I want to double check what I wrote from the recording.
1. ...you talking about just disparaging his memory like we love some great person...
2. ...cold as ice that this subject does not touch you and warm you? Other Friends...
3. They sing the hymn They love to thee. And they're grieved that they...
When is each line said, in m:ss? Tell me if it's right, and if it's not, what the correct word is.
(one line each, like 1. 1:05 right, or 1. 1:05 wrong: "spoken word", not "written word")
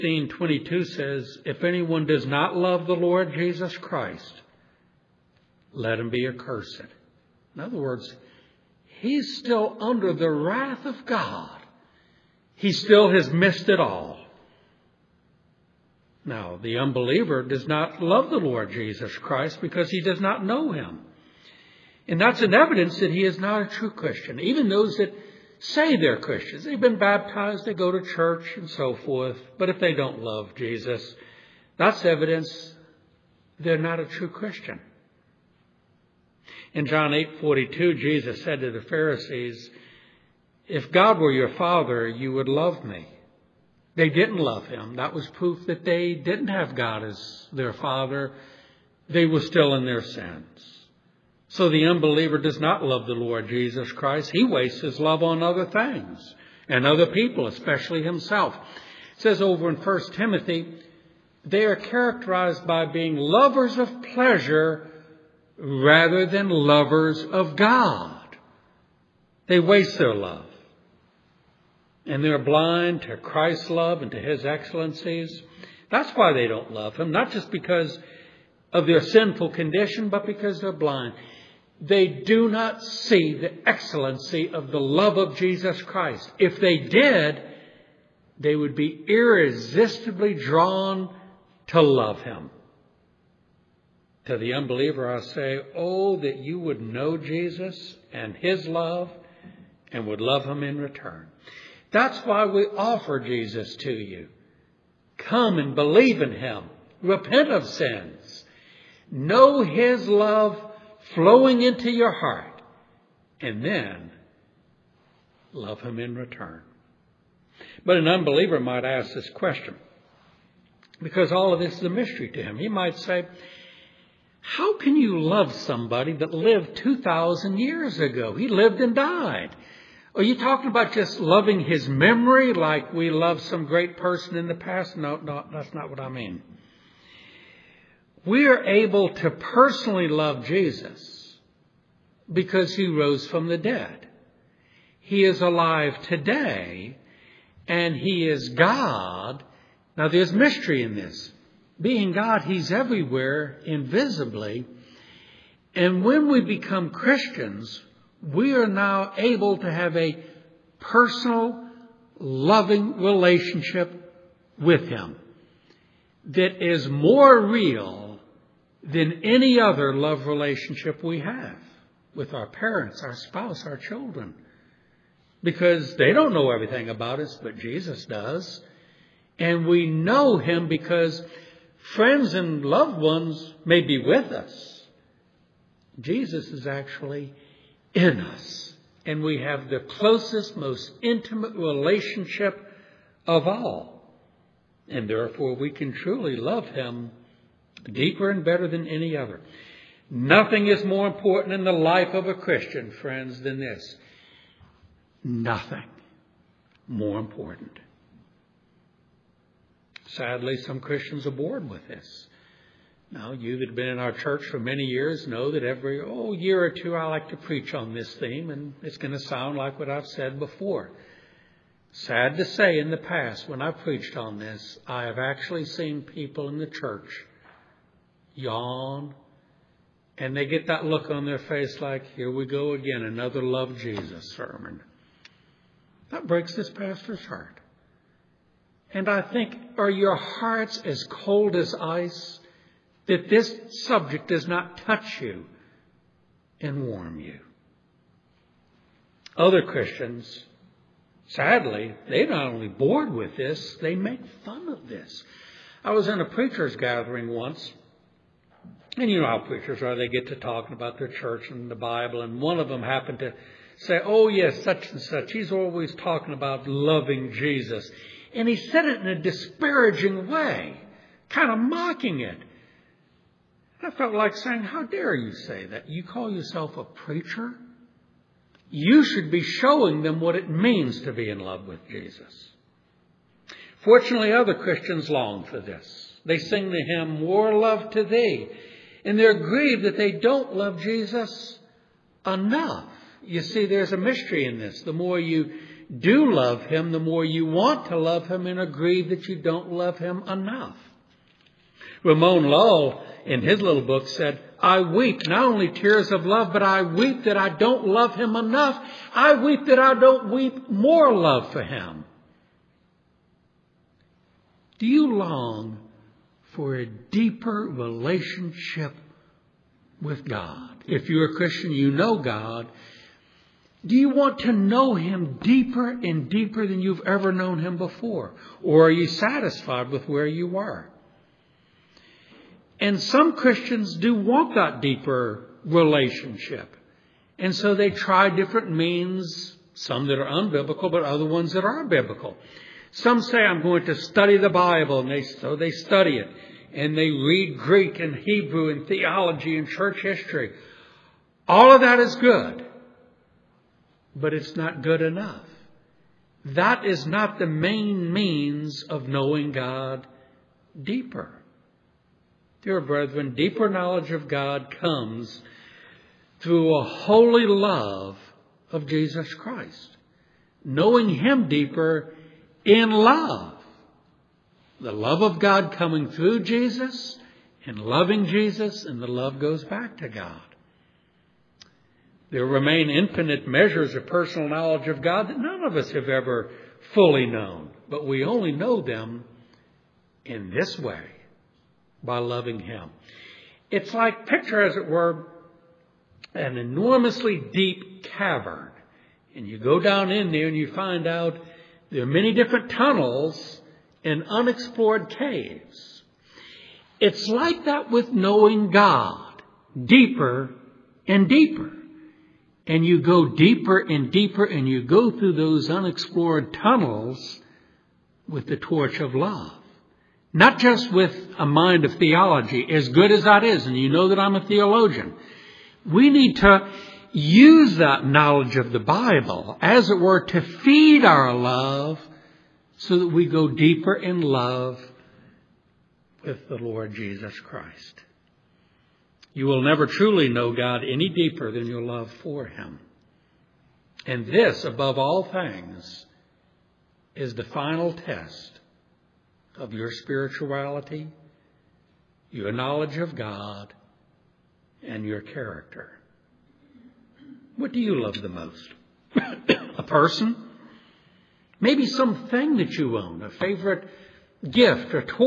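1. 2:10 wrong: "loving", not "disparaging"
2. 4:01 wrong: "Christians", not "Friends"
3. 4:46 wrong: "More", not "They".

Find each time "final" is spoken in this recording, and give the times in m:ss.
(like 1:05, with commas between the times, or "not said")
7:27.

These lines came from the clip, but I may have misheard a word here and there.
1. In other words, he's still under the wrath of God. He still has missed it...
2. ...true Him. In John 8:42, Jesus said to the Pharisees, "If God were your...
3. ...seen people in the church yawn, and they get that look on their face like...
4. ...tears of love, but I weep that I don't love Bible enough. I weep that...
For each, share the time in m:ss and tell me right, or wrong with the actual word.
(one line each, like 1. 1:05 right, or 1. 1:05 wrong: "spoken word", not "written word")
1. 0:07 right
2. 0:34 wrong: "Christian", not "Him"
3. 3:45 right
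4. 5:05 wrong: "Him", not "Bible".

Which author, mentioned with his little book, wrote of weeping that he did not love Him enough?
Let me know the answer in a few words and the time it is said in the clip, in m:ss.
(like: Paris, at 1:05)
Ramon Lull, at 5:02.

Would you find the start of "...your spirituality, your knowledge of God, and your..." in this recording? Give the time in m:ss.
7:29.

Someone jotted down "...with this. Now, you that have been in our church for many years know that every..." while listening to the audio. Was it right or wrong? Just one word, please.
right.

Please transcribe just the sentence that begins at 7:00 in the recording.
Not just with a mind of theology, as good as that is, and you know that I'm a theologian.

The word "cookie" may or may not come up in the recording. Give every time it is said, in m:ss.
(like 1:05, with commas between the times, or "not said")
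not said.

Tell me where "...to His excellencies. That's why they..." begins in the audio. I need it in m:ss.
1:14.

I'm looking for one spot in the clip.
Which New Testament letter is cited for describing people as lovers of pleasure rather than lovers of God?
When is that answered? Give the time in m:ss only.
0:59.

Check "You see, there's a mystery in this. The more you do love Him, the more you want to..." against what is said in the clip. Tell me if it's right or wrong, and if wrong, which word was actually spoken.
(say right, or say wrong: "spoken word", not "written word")
right.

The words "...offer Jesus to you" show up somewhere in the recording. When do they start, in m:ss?
1:42.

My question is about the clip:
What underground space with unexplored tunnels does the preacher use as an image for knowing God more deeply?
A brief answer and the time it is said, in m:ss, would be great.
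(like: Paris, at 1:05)
Cavern, at 6:38.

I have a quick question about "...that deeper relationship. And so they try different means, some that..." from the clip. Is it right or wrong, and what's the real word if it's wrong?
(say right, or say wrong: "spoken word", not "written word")
right.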